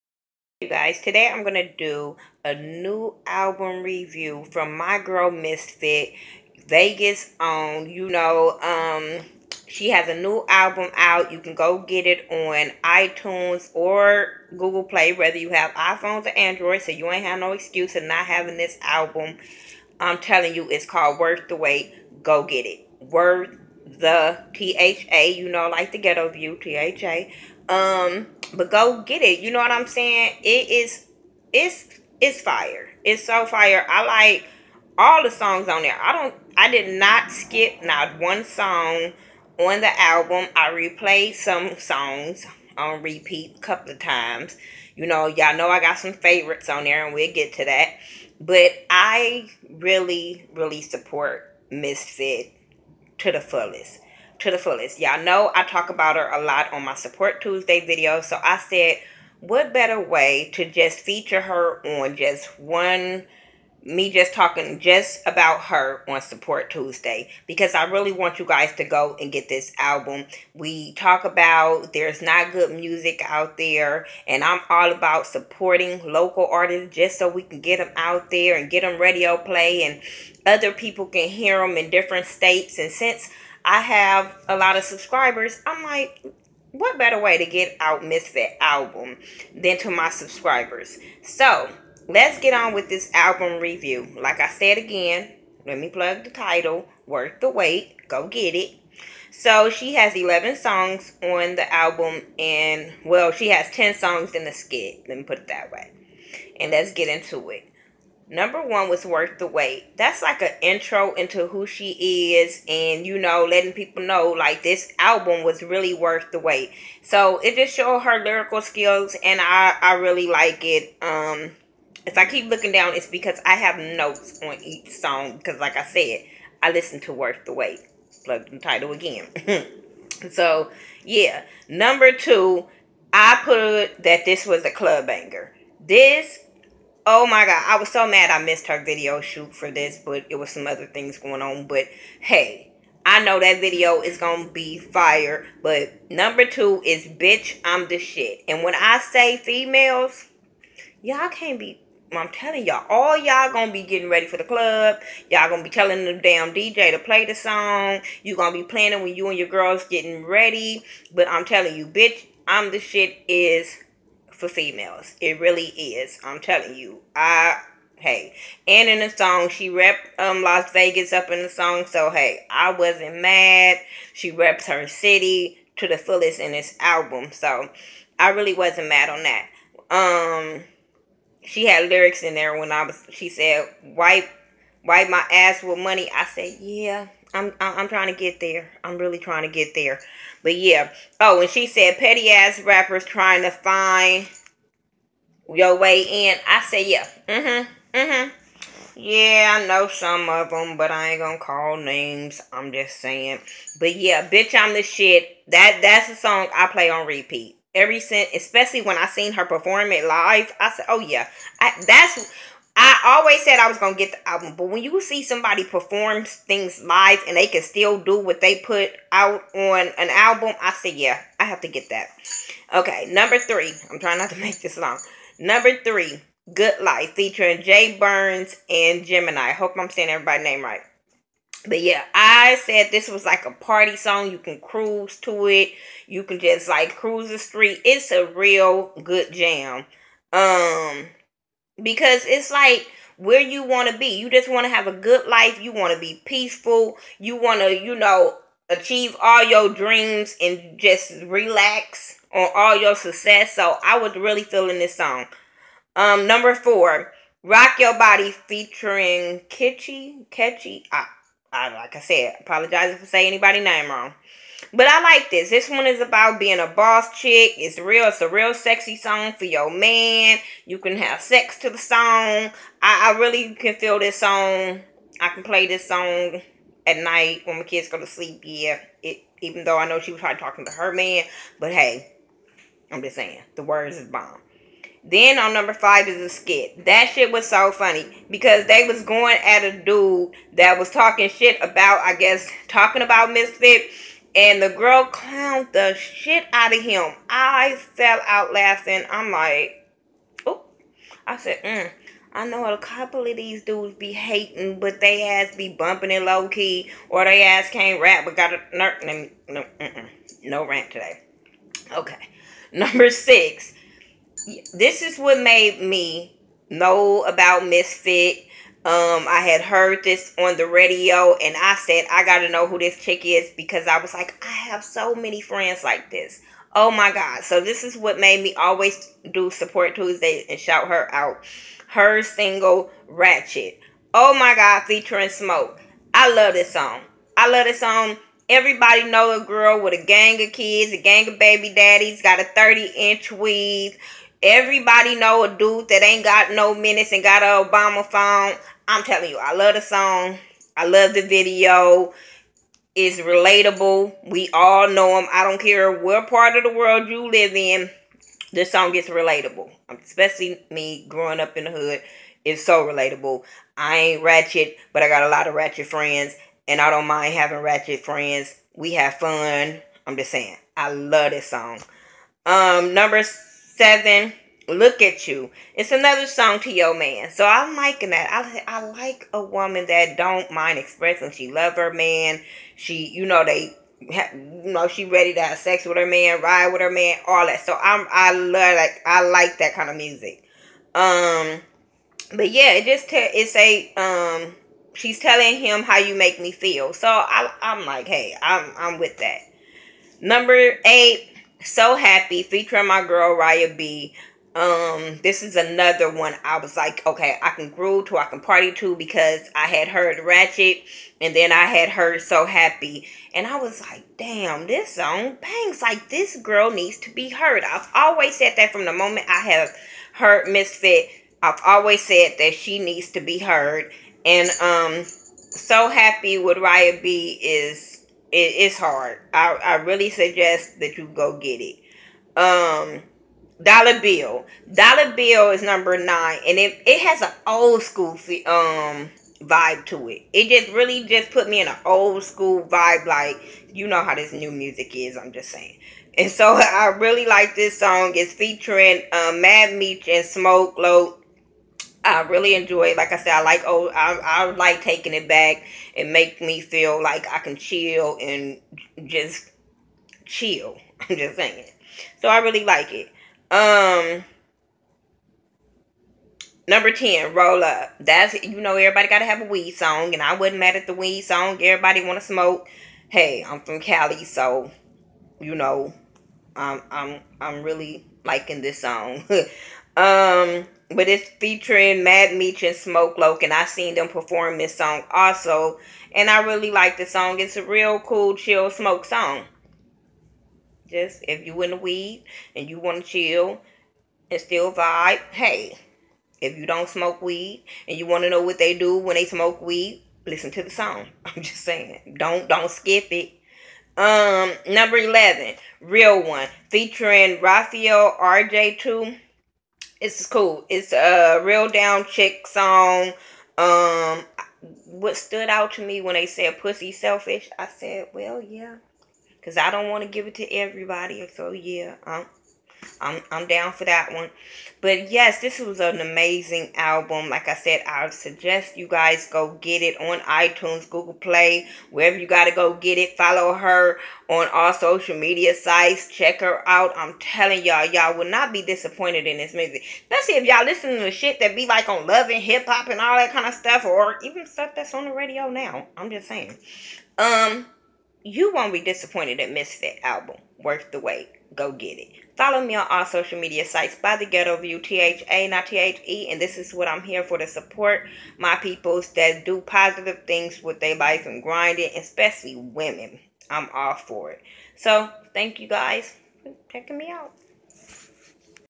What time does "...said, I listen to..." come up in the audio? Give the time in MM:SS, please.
02:05.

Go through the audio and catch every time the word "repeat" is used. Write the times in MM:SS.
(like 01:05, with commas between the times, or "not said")
00:43, 03:27.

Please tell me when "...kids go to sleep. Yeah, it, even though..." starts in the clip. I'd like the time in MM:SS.
04:37.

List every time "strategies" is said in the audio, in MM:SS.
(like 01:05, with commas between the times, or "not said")
not said.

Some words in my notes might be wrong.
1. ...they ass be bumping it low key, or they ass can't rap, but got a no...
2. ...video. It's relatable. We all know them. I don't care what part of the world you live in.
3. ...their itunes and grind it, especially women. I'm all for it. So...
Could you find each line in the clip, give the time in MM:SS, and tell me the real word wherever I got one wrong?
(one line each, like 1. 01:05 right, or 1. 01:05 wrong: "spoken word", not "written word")
1. 05:05 right
2. 05:51 right
3. 09:20 wrong: "lives", not "itunes".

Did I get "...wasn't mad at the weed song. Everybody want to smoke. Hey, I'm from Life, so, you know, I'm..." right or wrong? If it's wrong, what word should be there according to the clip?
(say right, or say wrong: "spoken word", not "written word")
wrong: "Cali", not "Life".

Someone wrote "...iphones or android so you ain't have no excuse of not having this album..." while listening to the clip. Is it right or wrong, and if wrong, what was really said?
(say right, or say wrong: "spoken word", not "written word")
right.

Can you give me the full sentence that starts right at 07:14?
Dollar Bill is number nine, and it it has an old school um vibe to it.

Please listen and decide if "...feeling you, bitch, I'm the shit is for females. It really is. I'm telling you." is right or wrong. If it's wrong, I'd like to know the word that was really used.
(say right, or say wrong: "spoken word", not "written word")
wrong: "telling", not "feeling".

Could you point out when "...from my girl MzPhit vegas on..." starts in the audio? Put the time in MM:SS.
00:04.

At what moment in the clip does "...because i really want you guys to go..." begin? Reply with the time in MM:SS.
01:07.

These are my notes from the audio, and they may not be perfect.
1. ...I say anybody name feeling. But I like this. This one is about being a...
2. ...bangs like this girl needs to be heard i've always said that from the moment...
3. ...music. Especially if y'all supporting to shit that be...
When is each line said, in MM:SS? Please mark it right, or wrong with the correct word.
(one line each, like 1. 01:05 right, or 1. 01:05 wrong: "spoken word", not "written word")
1. 04:23 wrong: "wrong", not "feeling"
2. 06:55 right
3. 08:59 wrong: "listening", not "supporting".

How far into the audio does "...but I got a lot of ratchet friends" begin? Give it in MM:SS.
06:04.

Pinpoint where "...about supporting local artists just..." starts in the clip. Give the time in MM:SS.
01:14.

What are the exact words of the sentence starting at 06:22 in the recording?
She, you know, they, you know, she ready to have sex with her man, ride with her man, all that.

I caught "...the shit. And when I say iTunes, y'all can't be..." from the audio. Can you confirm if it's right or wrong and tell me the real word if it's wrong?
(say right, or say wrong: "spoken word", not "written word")
wrong: "females", not "iTunes".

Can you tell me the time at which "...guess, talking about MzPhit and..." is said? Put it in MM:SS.
04:52.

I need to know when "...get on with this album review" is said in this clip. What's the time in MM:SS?
01:32.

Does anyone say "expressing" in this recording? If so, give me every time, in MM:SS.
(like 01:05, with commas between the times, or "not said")
06:20.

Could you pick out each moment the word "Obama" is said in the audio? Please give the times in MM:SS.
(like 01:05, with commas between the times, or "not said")
05:47.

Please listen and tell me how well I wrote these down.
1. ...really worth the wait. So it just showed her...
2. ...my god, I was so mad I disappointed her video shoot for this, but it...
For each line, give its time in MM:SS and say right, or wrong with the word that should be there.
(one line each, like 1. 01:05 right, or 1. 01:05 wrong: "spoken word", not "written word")
1. 01:55 right
2. 02:17 wrong: "missed", not "disappointed".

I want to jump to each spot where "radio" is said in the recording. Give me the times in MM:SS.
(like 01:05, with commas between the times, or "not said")
01:19, 05:20, 09:05.